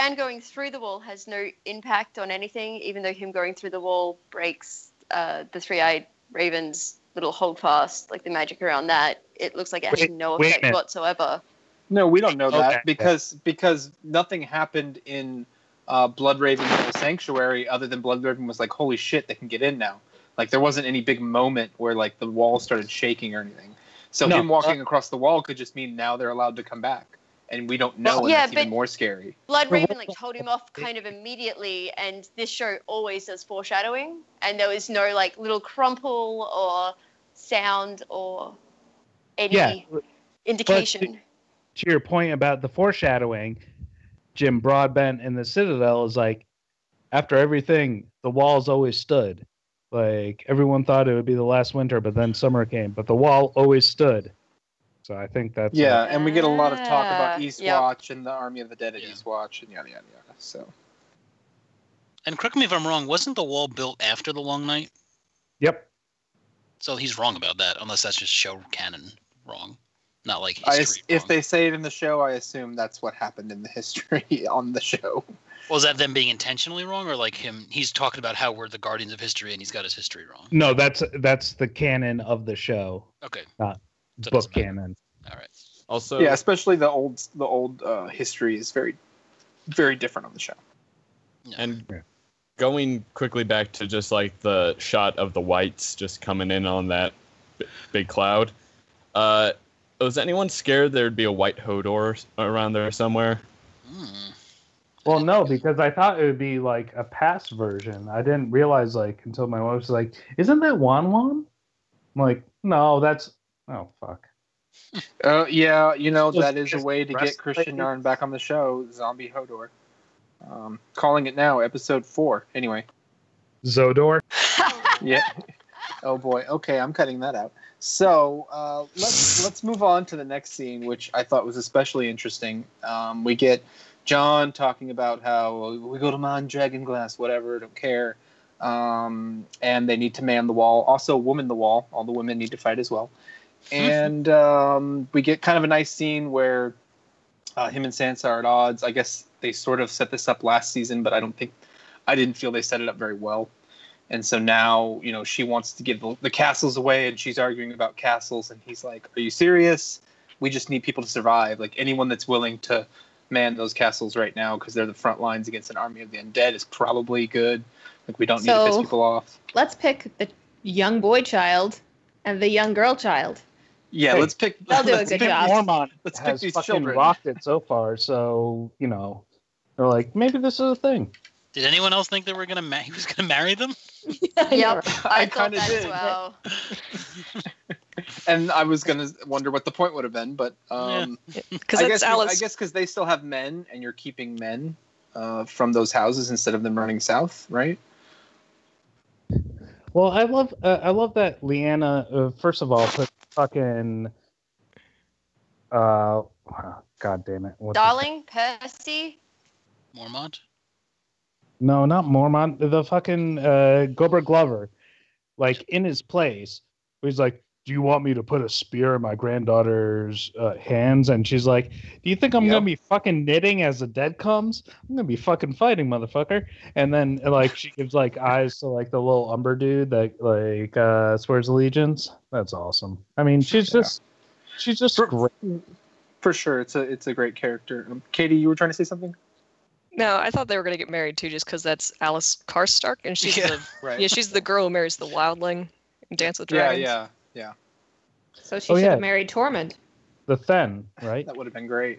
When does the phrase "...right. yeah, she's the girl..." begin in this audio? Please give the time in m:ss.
4:03.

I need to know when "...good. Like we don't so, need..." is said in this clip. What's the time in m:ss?
2:47.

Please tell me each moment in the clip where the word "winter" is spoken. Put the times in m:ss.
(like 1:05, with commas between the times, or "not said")
0:51.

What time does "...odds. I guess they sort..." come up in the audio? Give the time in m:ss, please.
2:28.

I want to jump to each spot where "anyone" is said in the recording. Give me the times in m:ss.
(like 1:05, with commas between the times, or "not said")
1:40, 2:41, 3:01.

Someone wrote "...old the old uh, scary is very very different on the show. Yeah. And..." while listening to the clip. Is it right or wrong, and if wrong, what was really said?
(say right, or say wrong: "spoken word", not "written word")
wrong: "history", not "scary".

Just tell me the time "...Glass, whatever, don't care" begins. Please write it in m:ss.
2:16.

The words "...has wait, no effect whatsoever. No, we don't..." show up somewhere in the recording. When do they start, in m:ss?
0:09.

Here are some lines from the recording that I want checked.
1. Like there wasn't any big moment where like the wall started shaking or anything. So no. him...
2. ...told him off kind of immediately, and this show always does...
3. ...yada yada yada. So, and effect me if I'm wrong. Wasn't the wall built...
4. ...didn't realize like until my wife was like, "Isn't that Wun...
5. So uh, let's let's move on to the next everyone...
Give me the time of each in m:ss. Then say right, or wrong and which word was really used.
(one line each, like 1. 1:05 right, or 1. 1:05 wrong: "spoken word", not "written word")
1. 0:20 right
2. 0:30 right
3. 0:59 wrong: "correct", not "effect"
4. 1:48 right
5. 2:07 wrong: "scene", not "everyone".